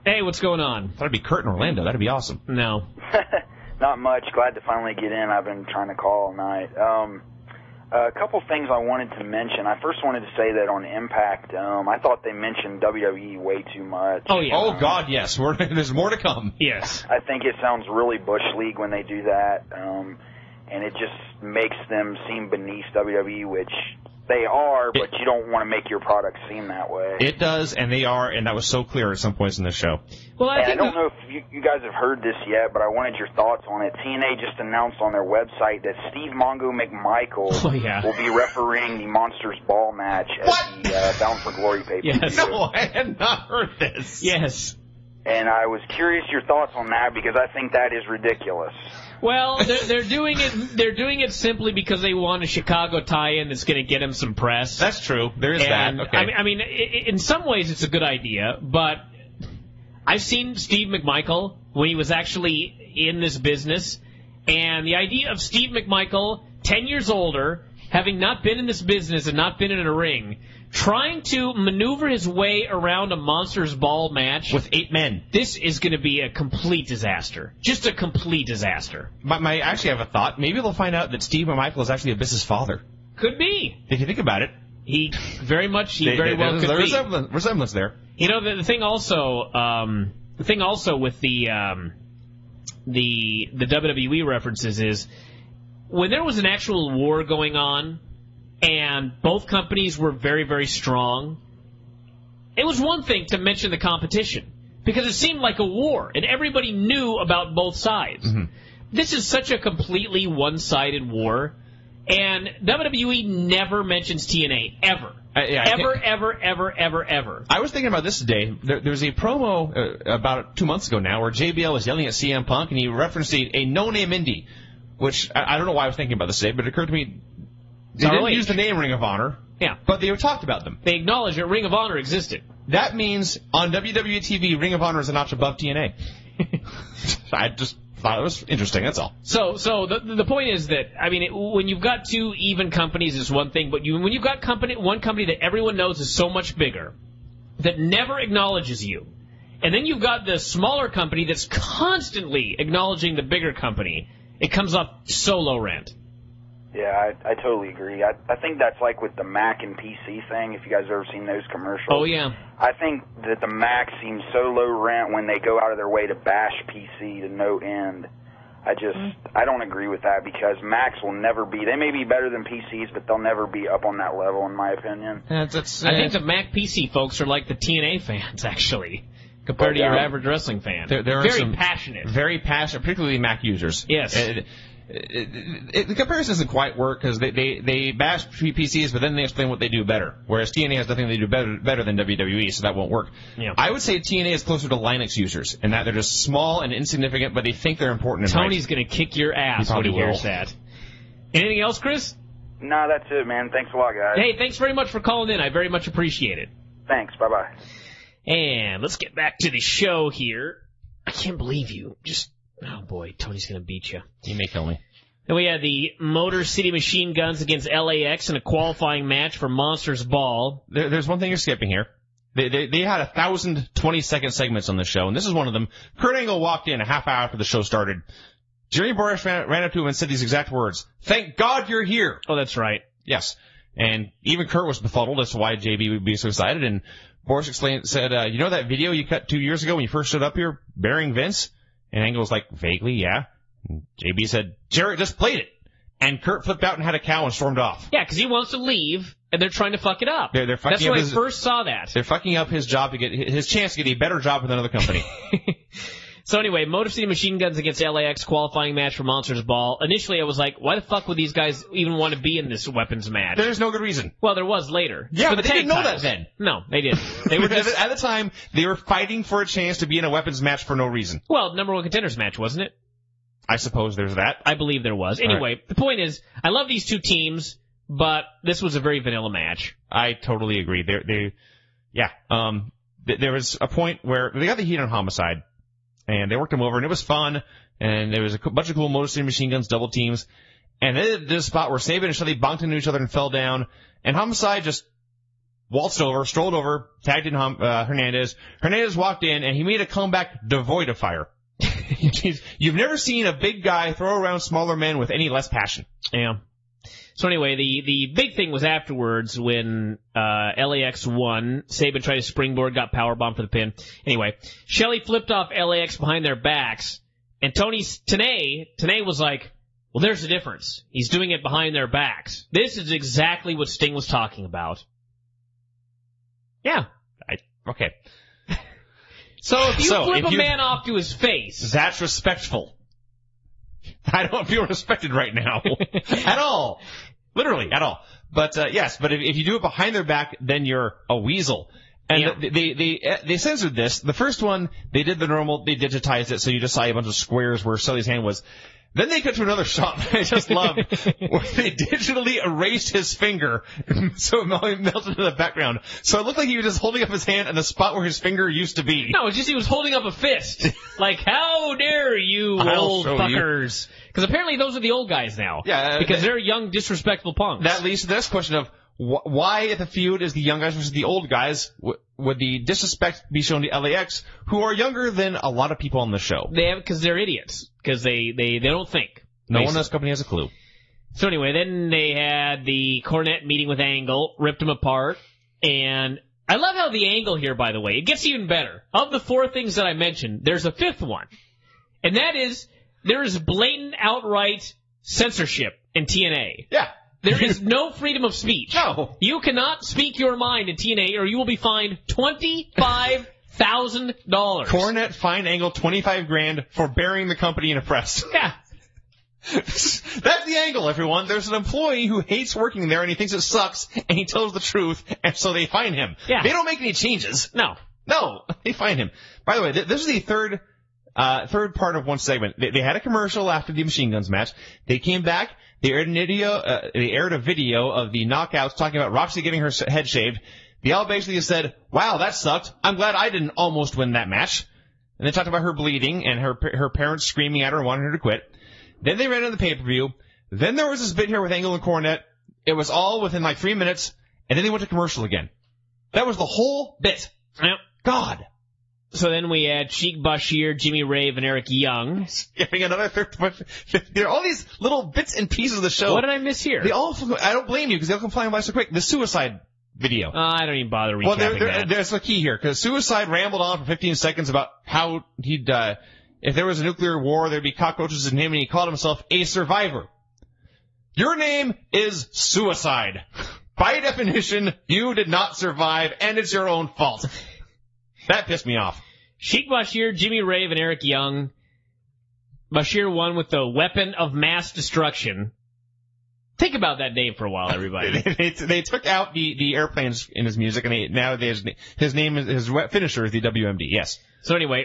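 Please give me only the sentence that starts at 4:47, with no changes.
And there was a bunch of cool Motor City Machine Guns double teams.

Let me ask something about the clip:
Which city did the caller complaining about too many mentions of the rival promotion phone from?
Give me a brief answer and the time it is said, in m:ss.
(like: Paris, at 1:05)
Orlando, at 0:01.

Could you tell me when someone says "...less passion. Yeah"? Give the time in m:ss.
5:05.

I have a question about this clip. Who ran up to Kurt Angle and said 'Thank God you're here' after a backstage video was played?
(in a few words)
Jerry Borash.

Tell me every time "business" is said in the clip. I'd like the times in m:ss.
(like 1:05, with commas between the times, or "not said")
1:03, 1:08.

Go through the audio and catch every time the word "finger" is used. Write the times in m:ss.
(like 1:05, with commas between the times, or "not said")
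5:53, 5:58.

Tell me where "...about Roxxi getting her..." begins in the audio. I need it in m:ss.
7:09.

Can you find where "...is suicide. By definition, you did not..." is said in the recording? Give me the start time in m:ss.
7:51.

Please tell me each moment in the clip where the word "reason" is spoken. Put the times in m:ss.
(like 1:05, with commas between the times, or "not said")
4:23, 4:30.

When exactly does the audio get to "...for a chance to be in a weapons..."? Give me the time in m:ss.
4:29.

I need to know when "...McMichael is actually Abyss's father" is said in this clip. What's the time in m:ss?
1:21.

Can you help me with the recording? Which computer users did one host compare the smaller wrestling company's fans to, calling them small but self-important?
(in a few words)
Linux users.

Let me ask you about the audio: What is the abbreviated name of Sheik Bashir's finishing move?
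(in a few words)
WMD.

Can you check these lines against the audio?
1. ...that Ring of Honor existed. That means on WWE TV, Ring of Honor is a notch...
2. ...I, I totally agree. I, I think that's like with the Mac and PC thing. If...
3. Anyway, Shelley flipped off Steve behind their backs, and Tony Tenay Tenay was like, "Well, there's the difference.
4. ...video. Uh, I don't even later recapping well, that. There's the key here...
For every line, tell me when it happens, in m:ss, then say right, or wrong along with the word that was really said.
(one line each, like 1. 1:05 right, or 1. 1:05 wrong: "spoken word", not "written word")
1. 2:11 right
2. 2:37 right
3. 5:14 wrong: "LAX", not "Steve"
4. 7:39 wrong: "bother", not "later".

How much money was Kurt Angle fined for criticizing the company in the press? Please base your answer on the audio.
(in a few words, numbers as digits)
$25,000.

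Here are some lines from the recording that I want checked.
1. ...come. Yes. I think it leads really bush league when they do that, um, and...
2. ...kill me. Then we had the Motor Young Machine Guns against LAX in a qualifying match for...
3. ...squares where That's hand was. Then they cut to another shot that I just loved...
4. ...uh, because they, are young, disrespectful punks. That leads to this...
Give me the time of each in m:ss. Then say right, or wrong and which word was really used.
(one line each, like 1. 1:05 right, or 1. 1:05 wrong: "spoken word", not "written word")
1. 0:16 wrong: "sounds", not "leads"
2. 3:34 wrong: "City", not "Young"
3. 5:47 wrong: "Sully", not "That"
4. 6:05 right.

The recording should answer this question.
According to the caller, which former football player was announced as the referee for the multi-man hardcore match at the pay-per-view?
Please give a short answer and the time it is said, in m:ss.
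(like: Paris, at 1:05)
Steve Mongo McMichael, at 0:36.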